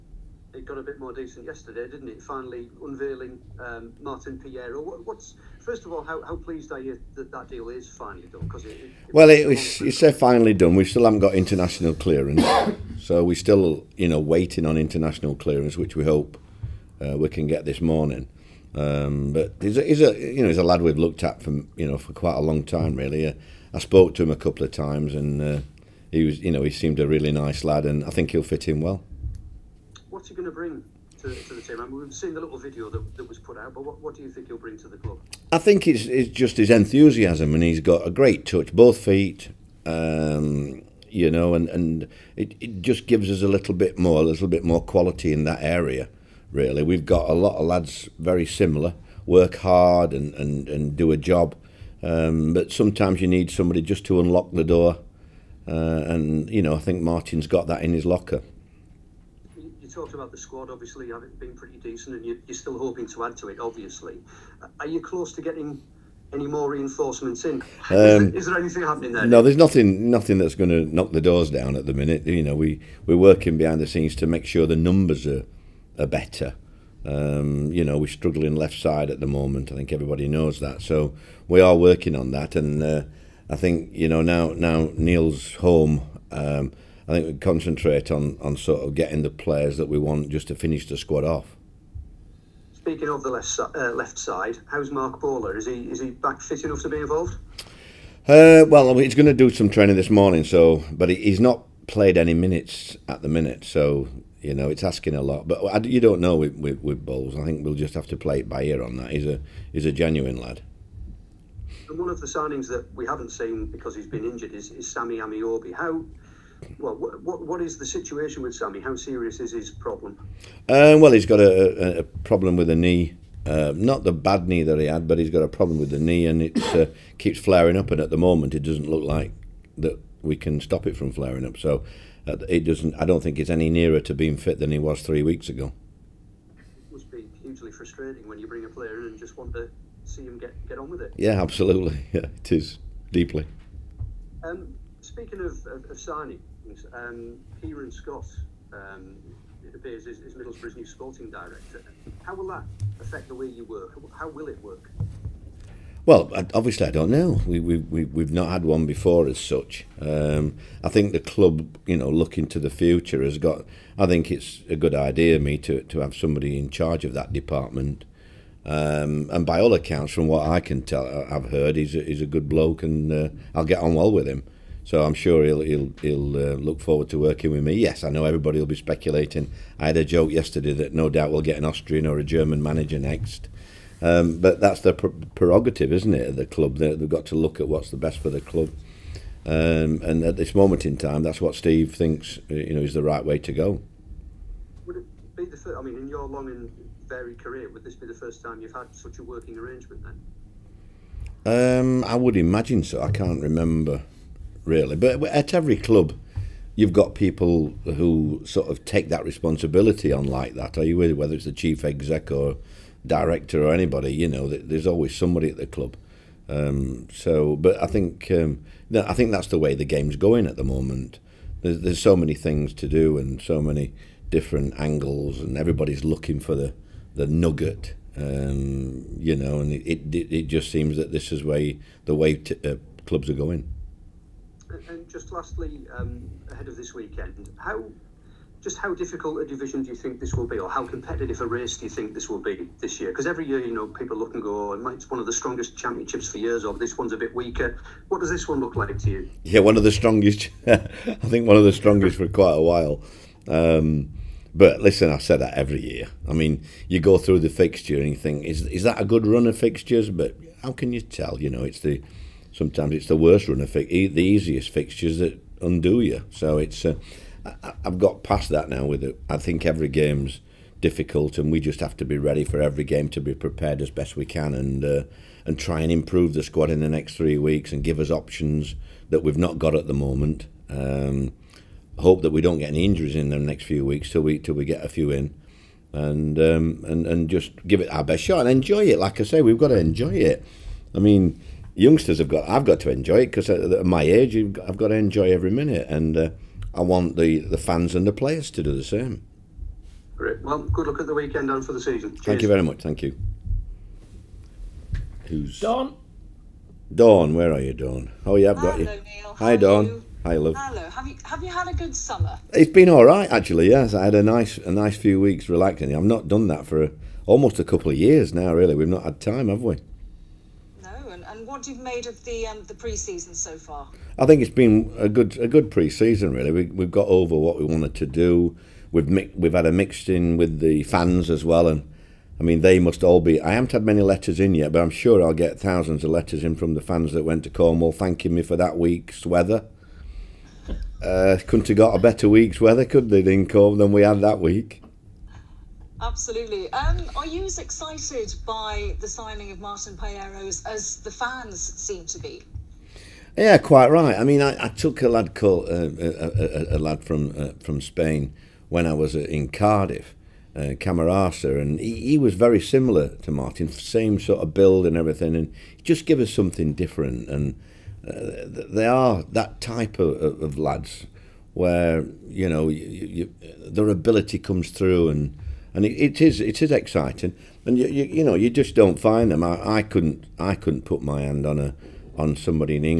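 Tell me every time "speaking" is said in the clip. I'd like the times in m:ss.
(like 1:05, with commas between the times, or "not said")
1:32, 2:25.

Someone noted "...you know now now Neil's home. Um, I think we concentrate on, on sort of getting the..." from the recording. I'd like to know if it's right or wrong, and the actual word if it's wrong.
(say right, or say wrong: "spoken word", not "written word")
right.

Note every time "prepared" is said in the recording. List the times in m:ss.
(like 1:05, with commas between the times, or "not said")
4:33.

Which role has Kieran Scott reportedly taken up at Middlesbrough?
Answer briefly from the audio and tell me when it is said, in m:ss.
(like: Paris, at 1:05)
Sporting director, at 2:30.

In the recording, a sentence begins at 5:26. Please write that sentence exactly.
We, we've got over what we wanted to do.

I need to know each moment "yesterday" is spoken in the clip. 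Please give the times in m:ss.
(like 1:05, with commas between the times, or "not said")
0:01, 3:00.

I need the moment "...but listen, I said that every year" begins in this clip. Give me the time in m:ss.
4:14.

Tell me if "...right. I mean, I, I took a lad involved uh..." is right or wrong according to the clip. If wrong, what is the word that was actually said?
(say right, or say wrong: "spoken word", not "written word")
wrong: "called", not "involved".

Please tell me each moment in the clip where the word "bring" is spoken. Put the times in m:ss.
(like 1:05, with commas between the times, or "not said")
0:30, 0:34, 2:18.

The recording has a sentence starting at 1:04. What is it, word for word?
Uh, are you close to getting any more reinforcements in?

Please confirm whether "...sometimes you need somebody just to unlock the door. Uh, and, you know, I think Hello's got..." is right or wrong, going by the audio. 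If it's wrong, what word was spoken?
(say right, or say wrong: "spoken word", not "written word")
wrong: "Martin", not "Hello".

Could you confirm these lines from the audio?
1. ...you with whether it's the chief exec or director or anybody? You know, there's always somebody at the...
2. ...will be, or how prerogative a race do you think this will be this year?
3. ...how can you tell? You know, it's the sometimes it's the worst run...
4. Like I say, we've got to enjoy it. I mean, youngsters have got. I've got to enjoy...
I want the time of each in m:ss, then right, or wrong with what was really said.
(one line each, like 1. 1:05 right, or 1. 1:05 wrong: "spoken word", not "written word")
1. 3:30 right
2. 4:00 wrong: "competitive", not "prerogative"
3. 4:20 right
4. 4:48 right.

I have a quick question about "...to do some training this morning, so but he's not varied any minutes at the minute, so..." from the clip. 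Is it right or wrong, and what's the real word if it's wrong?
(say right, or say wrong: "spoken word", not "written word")
wrong: "played", not "varied".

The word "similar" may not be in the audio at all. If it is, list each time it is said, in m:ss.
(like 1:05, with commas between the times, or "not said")
0:48, 6:02.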